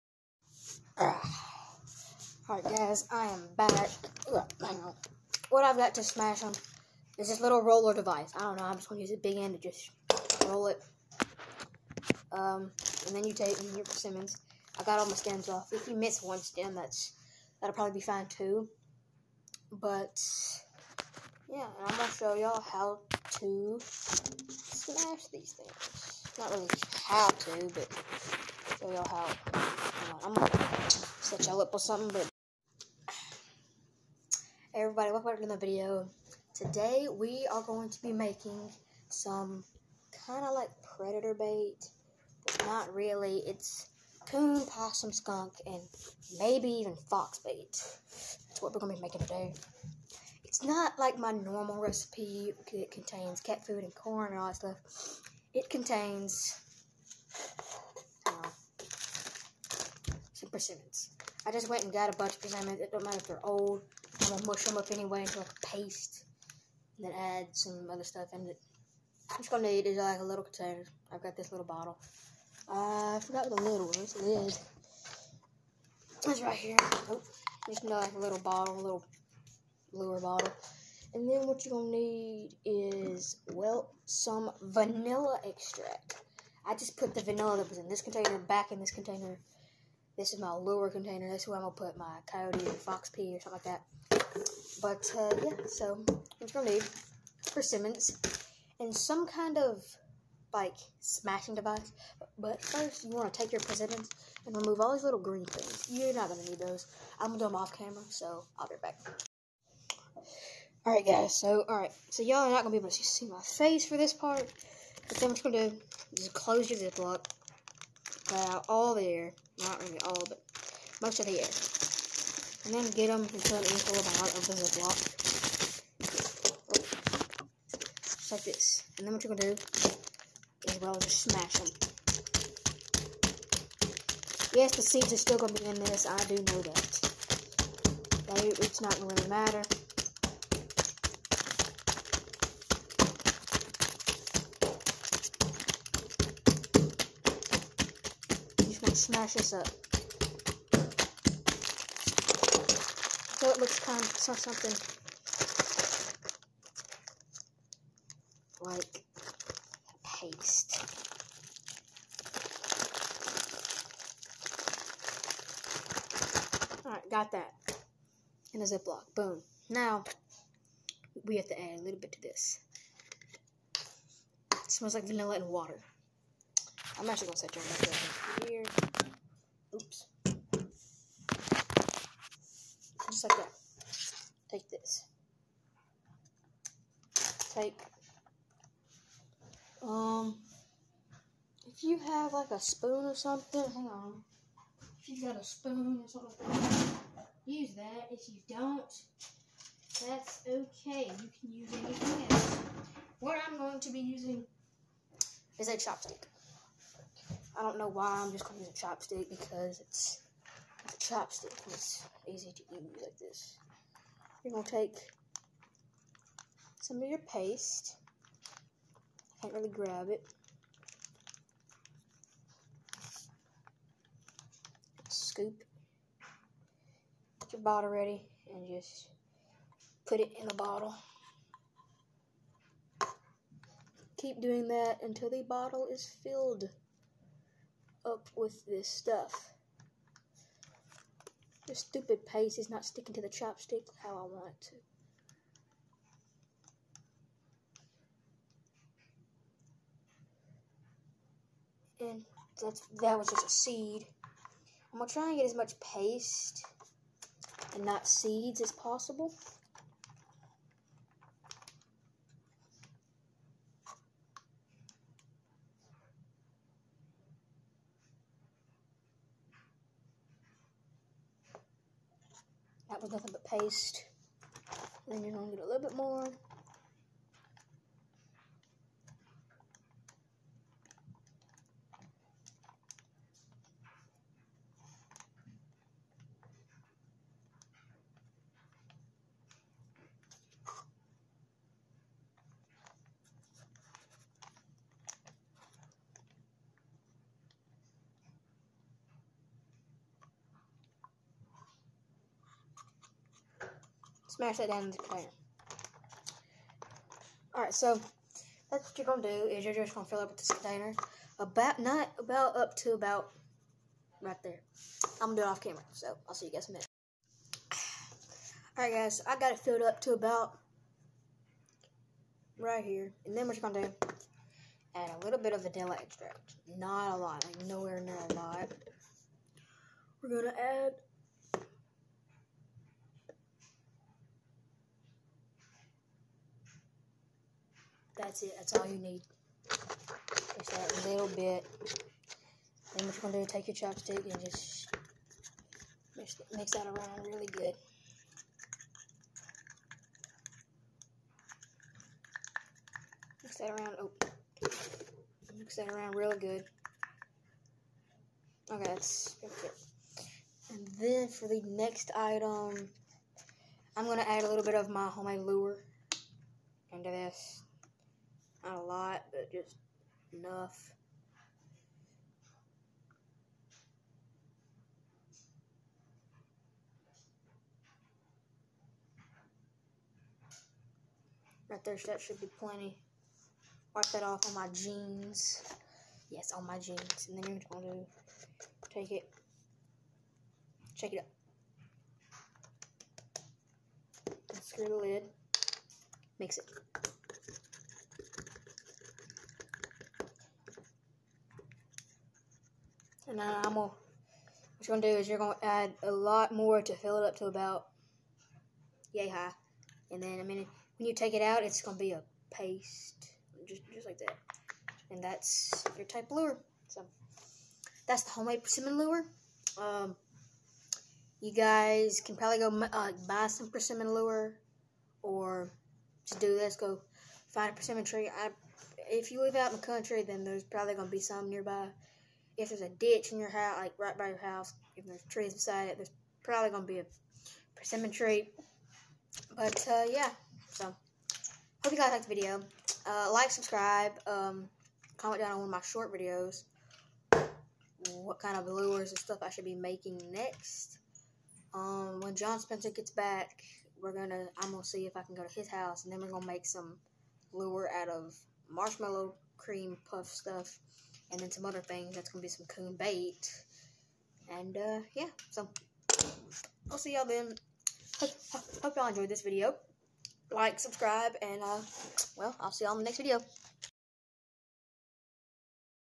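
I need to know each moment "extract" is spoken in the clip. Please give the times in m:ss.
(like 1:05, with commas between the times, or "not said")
1:25, 5:26.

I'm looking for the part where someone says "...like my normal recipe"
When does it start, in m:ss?
0:50.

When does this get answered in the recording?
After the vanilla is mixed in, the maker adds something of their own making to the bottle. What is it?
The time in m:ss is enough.
6:03.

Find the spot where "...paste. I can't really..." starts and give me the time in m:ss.
3:37.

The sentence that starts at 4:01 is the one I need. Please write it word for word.
This stupid paste is not sticking to the chopstick how I want it to.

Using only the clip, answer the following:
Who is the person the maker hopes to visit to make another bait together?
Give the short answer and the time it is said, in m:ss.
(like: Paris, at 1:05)
John Spencer, at 7:32.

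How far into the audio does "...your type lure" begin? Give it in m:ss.
6:55.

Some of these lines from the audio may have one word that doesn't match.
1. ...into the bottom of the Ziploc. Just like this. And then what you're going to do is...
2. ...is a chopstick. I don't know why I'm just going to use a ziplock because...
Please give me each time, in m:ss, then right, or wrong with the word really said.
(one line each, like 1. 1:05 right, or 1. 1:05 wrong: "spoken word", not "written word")
1. 2:03 right
2. 3:25 wrong: "chopstick", not "ziplock".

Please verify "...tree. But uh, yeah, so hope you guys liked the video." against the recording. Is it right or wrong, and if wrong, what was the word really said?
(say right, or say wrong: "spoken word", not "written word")
right.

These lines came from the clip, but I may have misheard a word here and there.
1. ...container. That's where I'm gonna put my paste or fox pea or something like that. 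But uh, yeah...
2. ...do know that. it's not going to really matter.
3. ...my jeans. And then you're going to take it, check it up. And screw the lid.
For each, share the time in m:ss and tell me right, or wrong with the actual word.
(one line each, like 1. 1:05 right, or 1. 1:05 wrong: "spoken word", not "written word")
1. 1:30 wrong: "coyote", not "paste"
2. 2:16 right
3. 6:26 right.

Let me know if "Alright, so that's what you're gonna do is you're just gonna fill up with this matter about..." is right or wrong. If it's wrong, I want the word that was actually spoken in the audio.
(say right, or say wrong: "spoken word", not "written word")
wrong: "container", not "matter".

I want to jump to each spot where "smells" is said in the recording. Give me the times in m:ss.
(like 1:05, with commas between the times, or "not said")
2:54.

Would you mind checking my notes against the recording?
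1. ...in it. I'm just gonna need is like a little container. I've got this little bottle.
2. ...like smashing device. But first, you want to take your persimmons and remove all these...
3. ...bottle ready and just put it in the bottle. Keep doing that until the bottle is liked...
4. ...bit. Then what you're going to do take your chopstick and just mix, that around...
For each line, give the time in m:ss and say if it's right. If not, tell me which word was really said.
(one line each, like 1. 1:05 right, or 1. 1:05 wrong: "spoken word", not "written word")
1. 1:08 right
2. 1:40 right
3. 3:47 wrong: "filled", not "liked"
4. 5:41 right.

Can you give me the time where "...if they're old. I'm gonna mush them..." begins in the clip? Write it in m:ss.
1:03.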